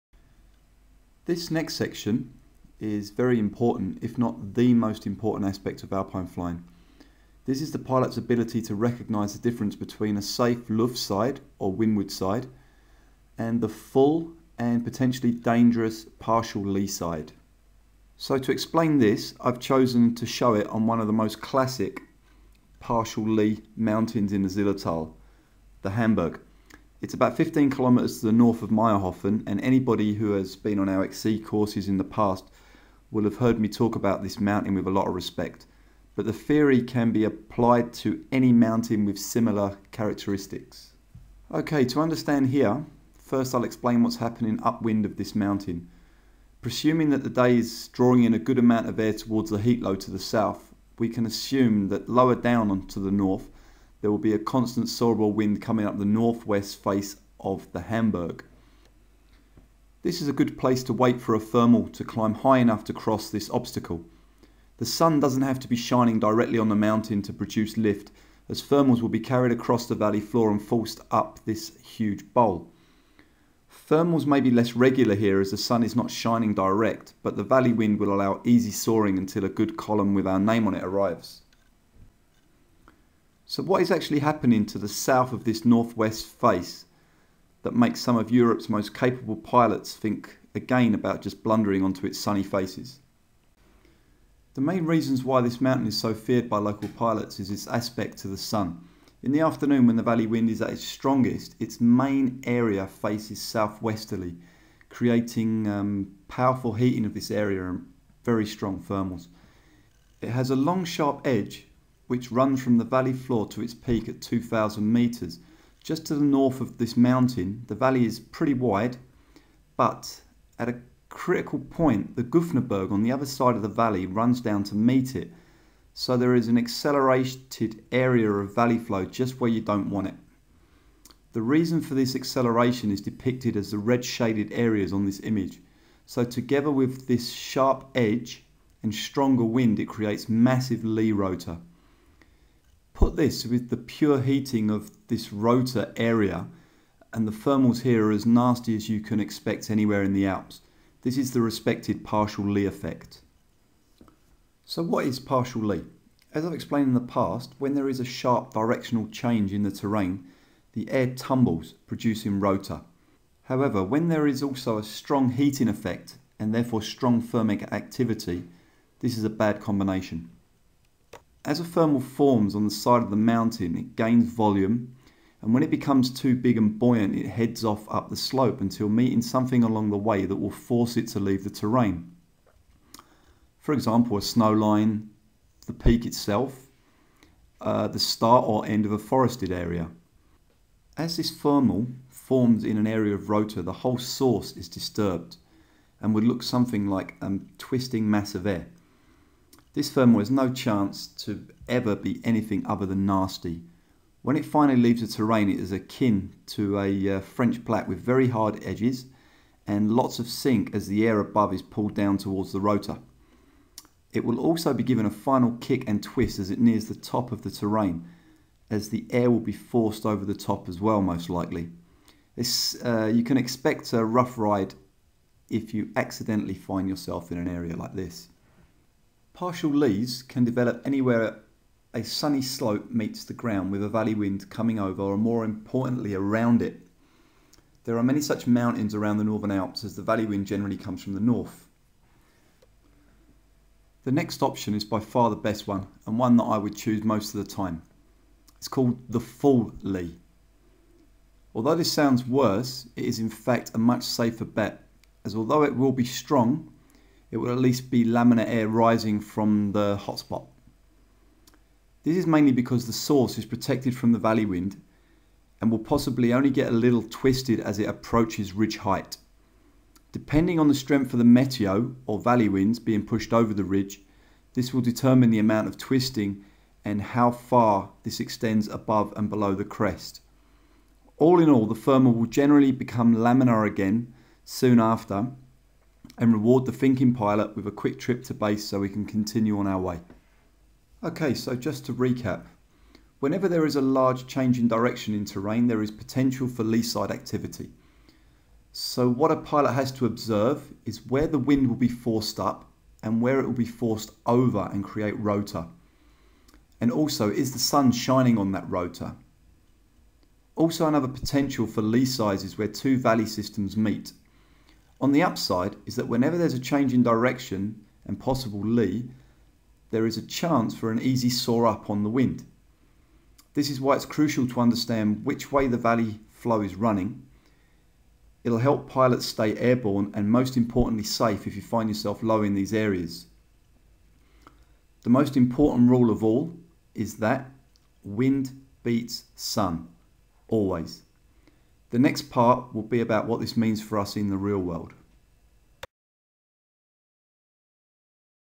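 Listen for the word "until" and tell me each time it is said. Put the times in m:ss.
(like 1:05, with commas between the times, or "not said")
1:19, 2:58.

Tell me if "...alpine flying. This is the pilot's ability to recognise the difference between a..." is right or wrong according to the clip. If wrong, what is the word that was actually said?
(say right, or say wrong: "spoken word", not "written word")
right.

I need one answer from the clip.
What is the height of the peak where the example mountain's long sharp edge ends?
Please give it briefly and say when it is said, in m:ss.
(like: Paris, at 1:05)
2,000 metres, at 1:54.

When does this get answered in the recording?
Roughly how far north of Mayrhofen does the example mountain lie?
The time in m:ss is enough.
0:27.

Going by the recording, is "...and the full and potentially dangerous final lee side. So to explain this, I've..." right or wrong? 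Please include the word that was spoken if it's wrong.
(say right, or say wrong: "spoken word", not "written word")
wrong: "partial", not "final".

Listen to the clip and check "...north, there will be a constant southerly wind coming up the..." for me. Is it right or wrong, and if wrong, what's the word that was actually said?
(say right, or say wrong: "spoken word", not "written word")
right.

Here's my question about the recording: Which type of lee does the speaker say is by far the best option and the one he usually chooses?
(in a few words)
full lee.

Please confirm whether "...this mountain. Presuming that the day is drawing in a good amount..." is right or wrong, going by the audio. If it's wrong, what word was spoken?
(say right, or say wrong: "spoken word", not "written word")
right.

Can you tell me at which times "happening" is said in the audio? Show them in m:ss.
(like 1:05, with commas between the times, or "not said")
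0:44, 1:24.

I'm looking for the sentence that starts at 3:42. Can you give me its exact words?
This, uh, you can expect a rough ride if you accidentally find yourself in an area like this.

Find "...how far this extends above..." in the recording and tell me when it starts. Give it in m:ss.
4:37.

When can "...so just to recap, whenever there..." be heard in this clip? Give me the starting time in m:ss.
4:51.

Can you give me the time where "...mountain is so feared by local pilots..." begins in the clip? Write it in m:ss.
1:35.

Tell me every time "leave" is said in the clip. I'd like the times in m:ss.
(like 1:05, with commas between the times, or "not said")
3:01, 3:24.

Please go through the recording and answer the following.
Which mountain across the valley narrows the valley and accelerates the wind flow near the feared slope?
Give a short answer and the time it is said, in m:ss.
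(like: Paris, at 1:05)
Gufnerberg, at 2:02.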